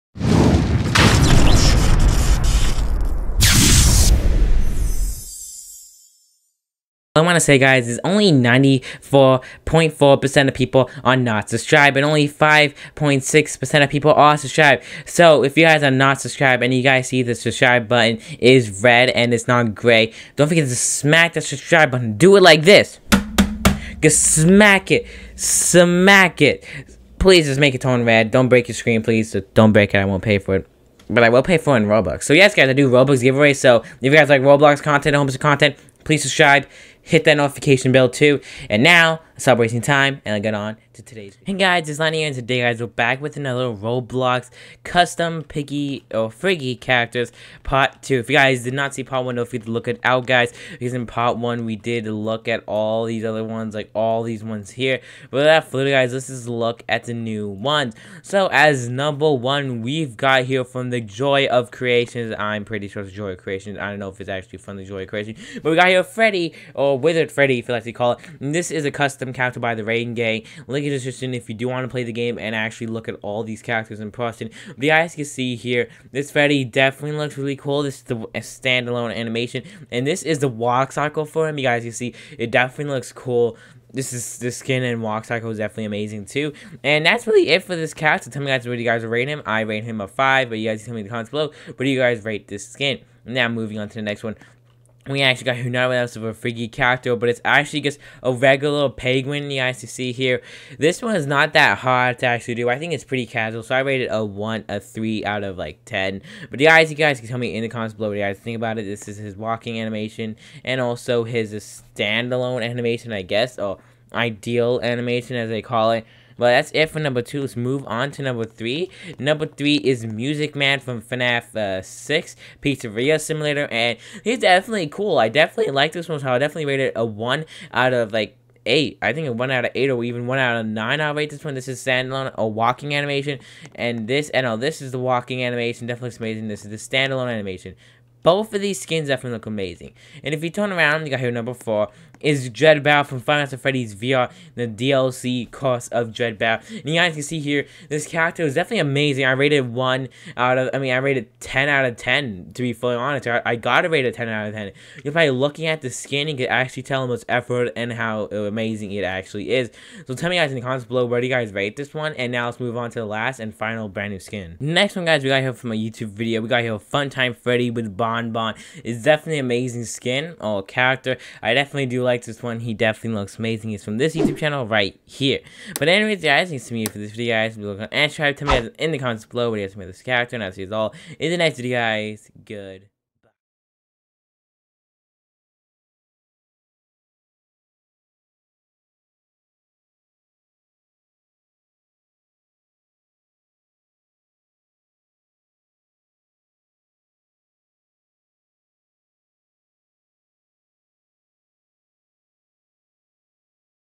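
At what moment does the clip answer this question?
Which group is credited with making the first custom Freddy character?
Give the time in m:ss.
1:09.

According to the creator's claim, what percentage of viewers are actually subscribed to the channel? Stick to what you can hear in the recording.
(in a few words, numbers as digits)
5.6%.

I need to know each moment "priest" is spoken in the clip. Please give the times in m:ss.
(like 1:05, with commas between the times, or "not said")
not said.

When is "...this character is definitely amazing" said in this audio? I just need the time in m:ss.
2:27.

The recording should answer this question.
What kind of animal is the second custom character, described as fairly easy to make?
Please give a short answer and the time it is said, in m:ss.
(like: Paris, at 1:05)
penguin, at 1:38.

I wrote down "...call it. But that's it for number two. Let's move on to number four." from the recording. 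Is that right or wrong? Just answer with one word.
wrong.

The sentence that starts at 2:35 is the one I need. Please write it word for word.
You're probably looking at the skin you could actually tell how much effort and how amazing it actually is.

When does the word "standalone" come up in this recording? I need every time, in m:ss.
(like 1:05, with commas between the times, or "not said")
1:18, 1:51, 2:11, 2:16.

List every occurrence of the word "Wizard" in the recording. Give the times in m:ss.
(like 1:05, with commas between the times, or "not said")
1:06.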